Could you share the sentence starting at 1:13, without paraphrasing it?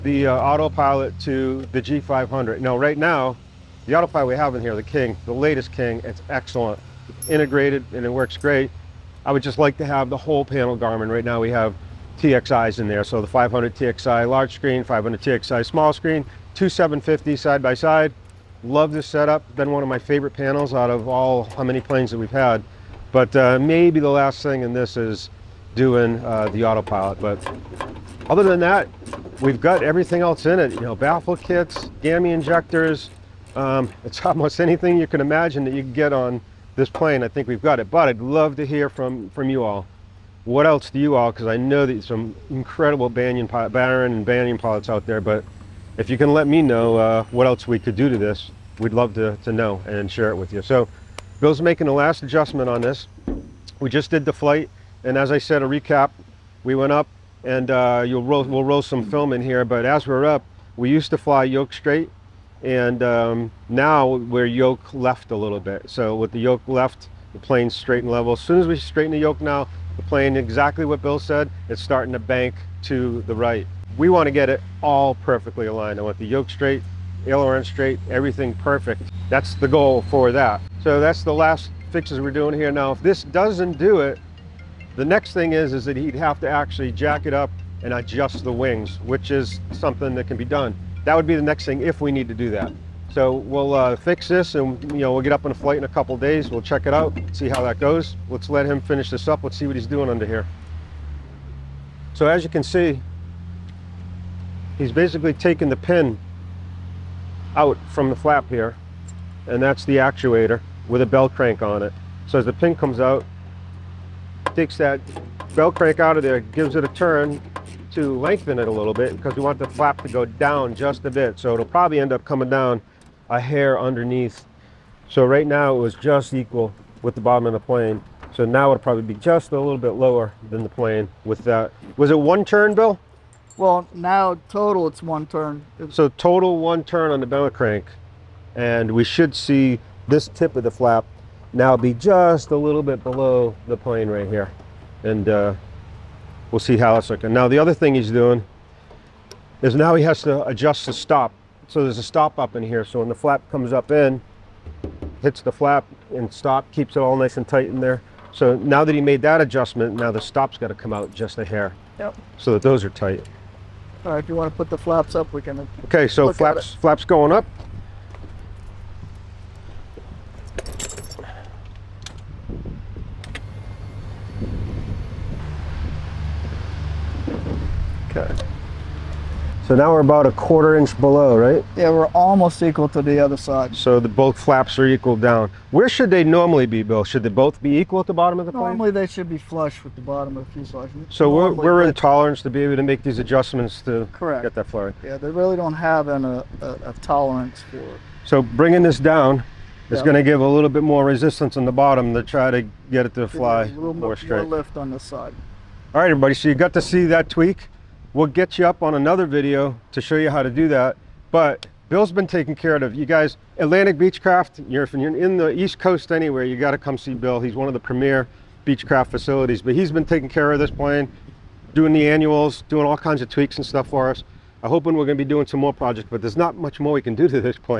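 We want to get it all perfectly aligned.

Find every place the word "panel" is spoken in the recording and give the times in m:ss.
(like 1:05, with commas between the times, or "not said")
0:10, 0:20.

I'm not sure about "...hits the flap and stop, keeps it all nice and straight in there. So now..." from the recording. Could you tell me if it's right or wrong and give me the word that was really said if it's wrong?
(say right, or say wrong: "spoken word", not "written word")
wrong: "tight", not "straight".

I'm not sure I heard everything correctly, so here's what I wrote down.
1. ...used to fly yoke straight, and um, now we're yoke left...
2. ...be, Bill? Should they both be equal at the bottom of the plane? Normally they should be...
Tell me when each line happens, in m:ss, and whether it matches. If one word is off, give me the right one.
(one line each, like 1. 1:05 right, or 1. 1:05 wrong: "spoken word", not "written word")
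1. 1:00 right
2. 3:06 right.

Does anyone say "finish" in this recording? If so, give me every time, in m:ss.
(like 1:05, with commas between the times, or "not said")
1:38.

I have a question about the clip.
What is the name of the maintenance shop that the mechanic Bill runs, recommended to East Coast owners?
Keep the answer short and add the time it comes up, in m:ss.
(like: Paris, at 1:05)
Atlantic Beechcraft, at 3:33.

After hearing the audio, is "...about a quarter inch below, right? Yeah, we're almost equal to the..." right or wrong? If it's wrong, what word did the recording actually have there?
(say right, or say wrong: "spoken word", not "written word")
right.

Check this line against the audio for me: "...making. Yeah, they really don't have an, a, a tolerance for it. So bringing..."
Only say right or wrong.
wrong.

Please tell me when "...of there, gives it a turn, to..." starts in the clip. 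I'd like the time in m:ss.
1:56.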